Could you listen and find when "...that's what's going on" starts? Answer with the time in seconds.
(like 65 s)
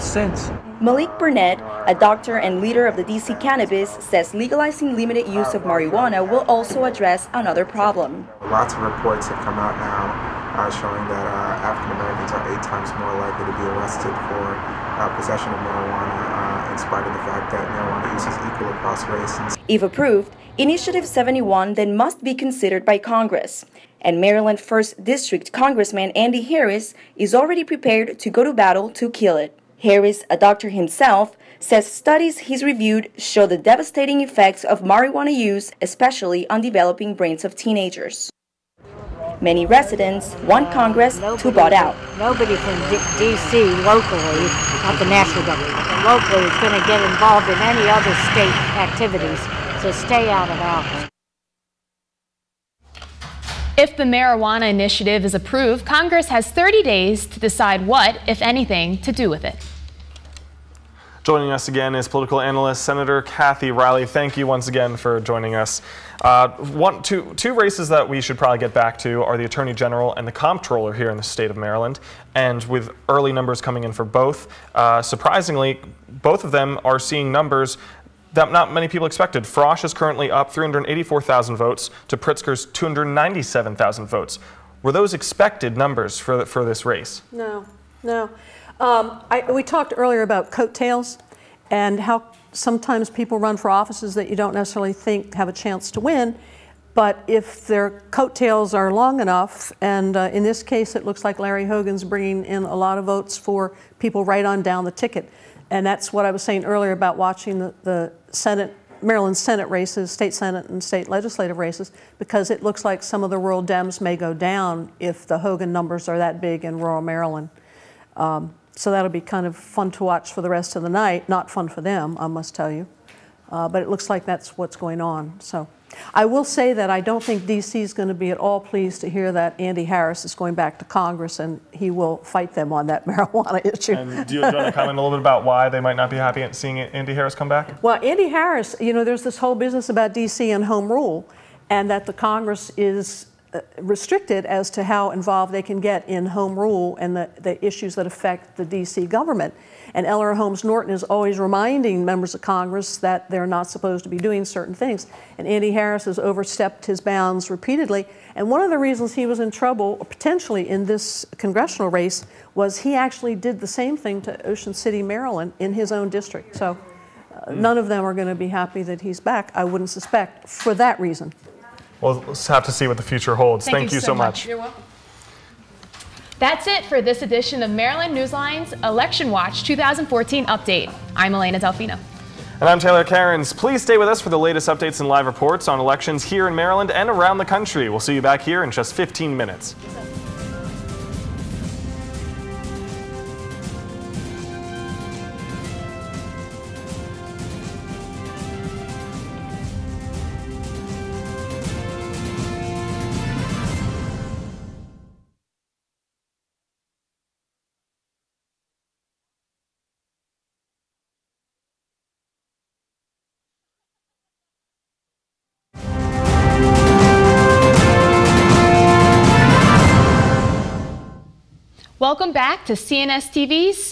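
124 s.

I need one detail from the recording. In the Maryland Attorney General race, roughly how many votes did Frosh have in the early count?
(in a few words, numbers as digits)
384,000.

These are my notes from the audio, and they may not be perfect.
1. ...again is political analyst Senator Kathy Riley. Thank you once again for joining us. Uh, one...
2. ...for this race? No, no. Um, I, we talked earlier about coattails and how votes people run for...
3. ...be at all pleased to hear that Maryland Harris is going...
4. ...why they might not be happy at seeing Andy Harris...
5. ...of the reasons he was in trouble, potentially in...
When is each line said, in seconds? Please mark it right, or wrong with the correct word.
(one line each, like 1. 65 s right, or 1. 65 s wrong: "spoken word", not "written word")
1. 61 s right
2. 86 s wrong: "sometimes", not "votes"
3. 128 s wrong: "Andy", not "Maryland"
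4. 135 s right
5. 158 s right.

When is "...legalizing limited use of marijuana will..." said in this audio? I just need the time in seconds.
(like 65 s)
4 s.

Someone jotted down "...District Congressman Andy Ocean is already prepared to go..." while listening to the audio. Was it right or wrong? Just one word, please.
wrong.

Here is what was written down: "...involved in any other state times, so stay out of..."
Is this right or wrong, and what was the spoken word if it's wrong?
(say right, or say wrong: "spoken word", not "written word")
wrong: "activities", not "times".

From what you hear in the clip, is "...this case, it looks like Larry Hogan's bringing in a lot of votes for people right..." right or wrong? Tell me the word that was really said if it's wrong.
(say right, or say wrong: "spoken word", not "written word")
right.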